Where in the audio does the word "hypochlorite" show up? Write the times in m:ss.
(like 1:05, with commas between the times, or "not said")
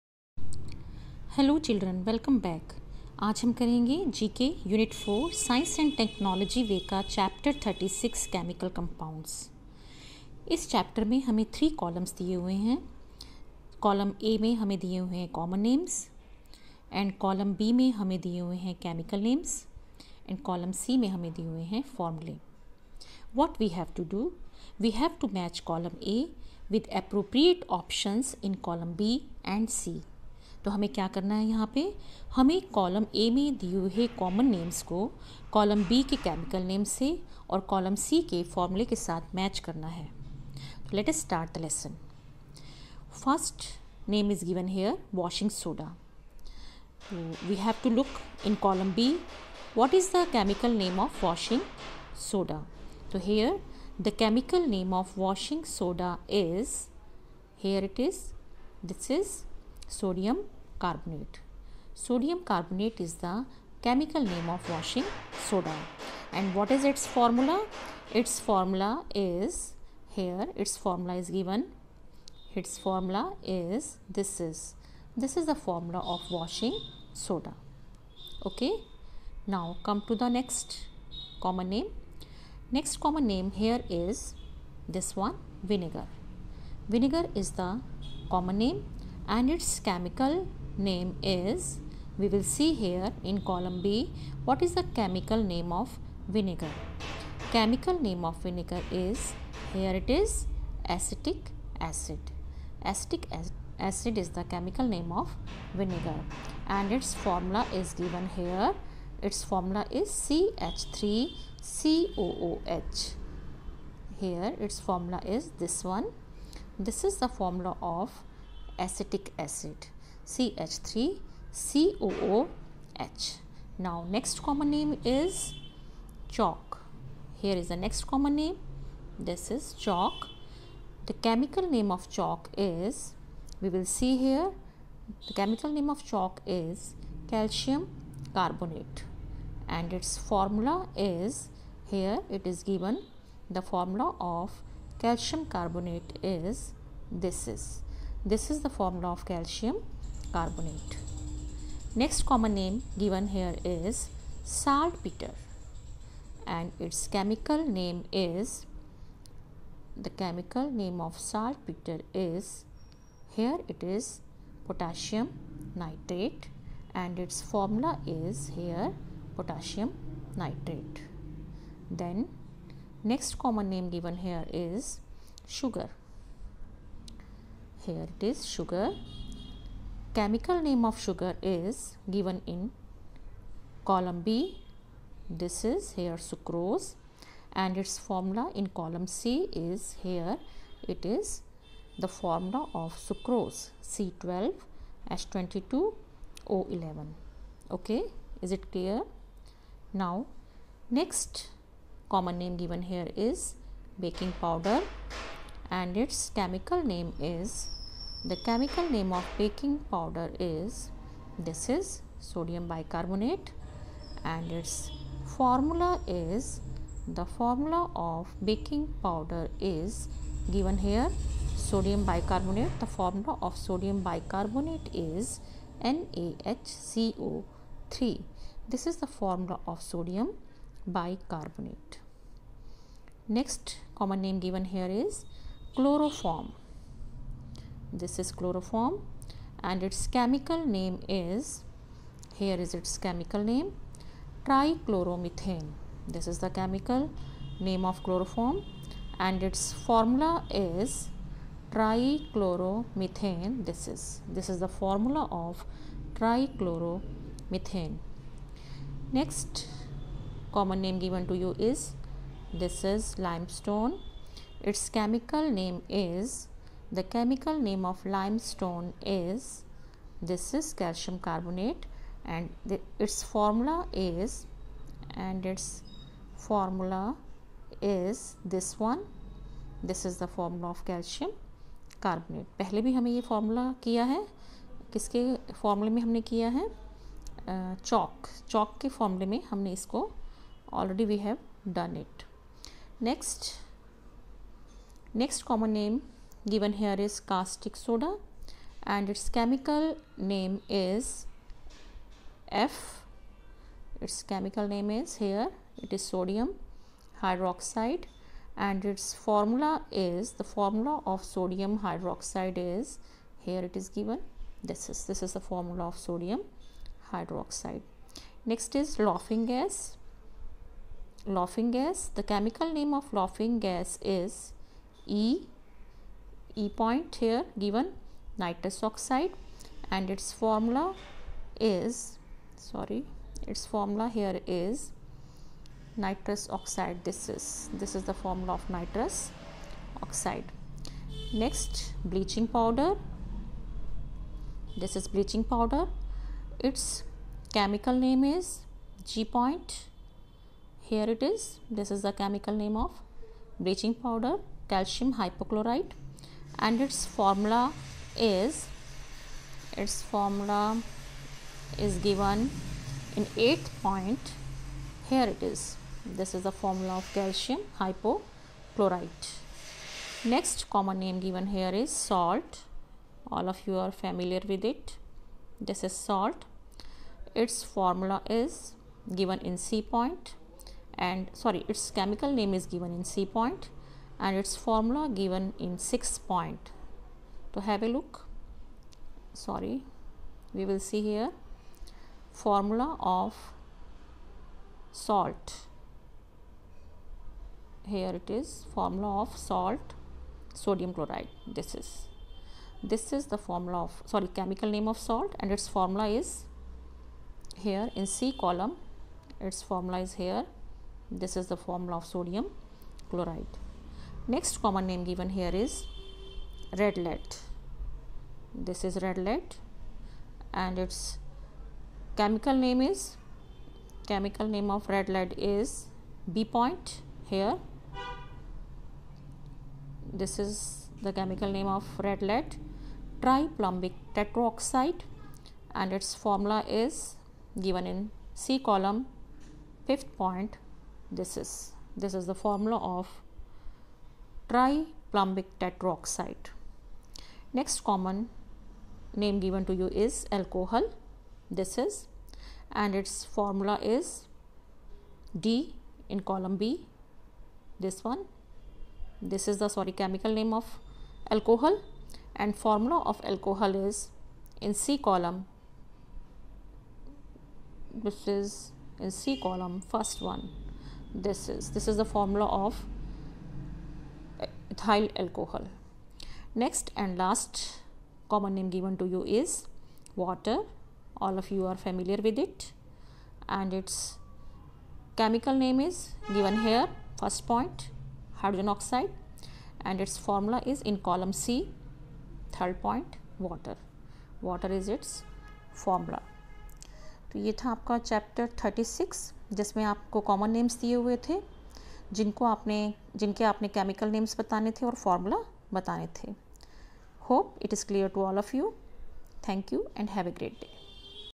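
5:55, 6:07.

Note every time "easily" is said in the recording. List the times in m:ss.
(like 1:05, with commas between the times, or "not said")
not said.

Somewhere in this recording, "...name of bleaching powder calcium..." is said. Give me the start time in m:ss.
5:52.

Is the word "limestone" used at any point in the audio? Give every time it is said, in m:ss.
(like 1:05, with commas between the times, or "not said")
4:23, 4:28.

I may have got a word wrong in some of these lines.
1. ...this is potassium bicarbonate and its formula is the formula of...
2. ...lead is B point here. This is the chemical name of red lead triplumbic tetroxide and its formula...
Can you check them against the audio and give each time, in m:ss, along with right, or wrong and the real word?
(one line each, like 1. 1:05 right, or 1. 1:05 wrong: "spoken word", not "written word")
1. 3:31 wrong: "sodium", not "potassium"
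2. 7:05 right.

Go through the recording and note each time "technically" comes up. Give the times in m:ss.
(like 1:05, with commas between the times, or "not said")
not said.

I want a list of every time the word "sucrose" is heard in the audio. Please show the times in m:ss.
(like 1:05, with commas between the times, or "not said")
3:06, 3:13.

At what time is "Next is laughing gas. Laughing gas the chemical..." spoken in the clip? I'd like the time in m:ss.
5:18.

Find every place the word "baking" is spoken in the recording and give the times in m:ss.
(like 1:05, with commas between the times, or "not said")
3:23, 3:29, 3:38.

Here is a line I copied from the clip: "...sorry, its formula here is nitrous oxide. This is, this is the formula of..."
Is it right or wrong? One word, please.
right.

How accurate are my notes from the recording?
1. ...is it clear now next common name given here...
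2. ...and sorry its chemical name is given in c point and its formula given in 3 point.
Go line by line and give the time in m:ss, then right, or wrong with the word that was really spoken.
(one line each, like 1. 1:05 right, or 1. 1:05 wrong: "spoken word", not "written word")
1. 3:18 right
2. 6:21 wrong: "6", not "3".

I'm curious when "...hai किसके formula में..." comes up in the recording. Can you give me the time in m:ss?
4:44.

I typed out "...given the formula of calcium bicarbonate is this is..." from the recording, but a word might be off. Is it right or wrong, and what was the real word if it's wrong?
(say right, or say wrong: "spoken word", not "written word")
wrong: "carbonate", not "bicarbonate".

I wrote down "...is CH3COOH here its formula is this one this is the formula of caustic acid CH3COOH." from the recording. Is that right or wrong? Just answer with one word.
wrong.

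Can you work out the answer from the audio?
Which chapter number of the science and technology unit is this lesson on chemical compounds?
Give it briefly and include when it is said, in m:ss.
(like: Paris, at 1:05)
36, at 0:07.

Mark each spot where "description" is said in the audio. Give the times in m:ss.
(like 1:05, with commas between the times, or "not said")
not said.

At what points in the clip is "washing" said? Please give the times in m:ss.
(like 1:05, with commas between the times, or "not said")
1:04, 1:16.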